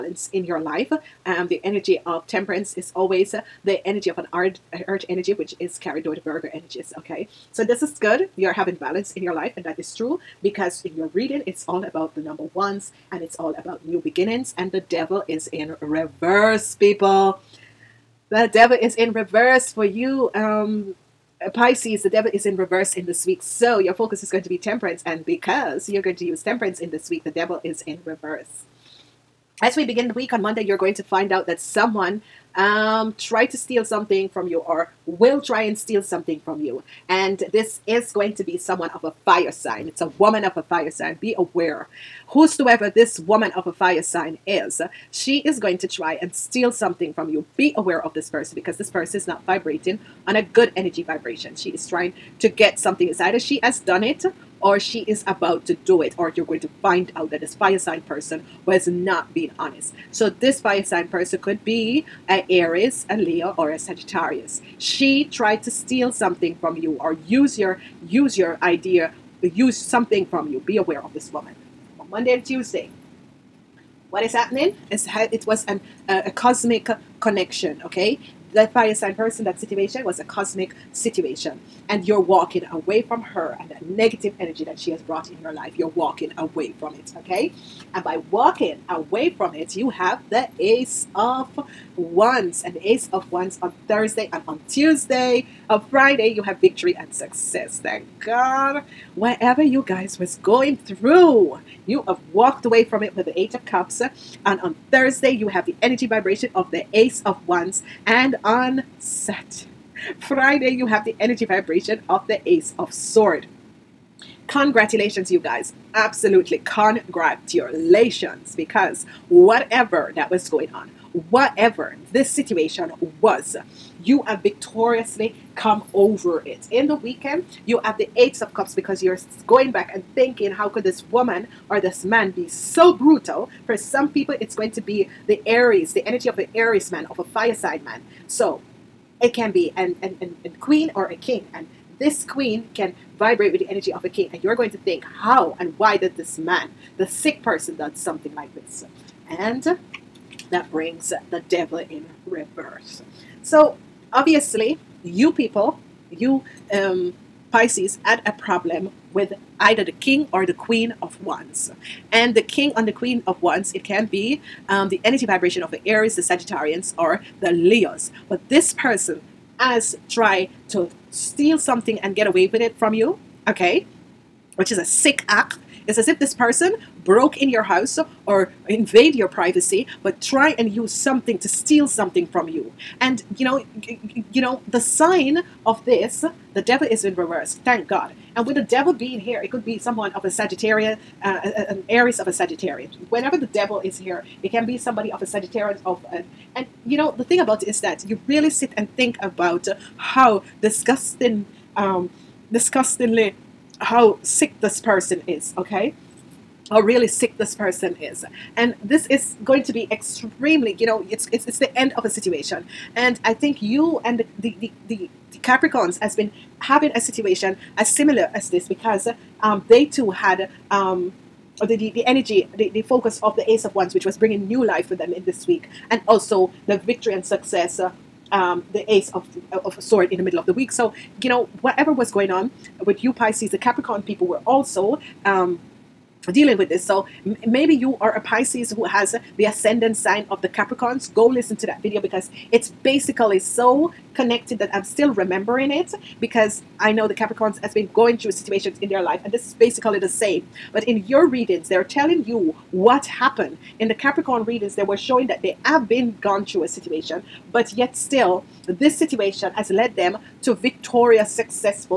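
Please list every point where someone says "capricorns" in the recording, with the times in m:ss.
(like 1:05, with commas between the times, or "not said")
3:35, 3:53, 4:00, 4:07, 4:13.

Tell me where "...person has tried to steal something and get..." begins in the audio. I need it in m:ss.
2:48.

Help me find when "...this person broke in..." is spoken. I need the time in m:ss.
2:56.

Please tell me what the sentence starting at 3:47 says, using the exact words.
Uh, um, the ace of of a sword in the middle of the week.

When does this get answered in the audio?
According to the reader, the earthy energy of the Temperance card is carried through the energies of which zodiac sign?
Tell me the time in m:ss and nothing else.
0:06.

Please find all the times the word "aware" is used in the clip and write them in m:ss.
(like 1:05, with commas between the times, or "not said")
0:41, 0:47, 1:10.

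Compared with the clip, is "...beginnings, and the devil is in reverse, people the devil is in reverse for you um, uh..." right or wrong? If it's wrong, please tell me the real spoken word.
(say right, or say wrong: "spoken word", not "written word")
right.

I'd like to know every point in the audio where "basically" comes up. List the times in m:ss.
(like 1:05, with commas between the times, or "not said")
4:02, 4:09.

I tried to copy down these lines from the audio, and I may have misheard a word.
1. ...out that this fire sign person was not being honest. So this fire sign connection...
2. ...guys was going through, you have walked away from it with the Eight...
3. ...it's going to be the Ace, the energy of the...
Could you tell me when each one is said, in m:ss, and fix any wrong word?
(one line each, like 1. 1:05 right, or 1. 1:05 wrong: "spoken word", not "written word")
1. 0:57 wrong: "person", not "connection"
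2. 1:39 right
3. 2:14 wrong: "Aries", not "Ace".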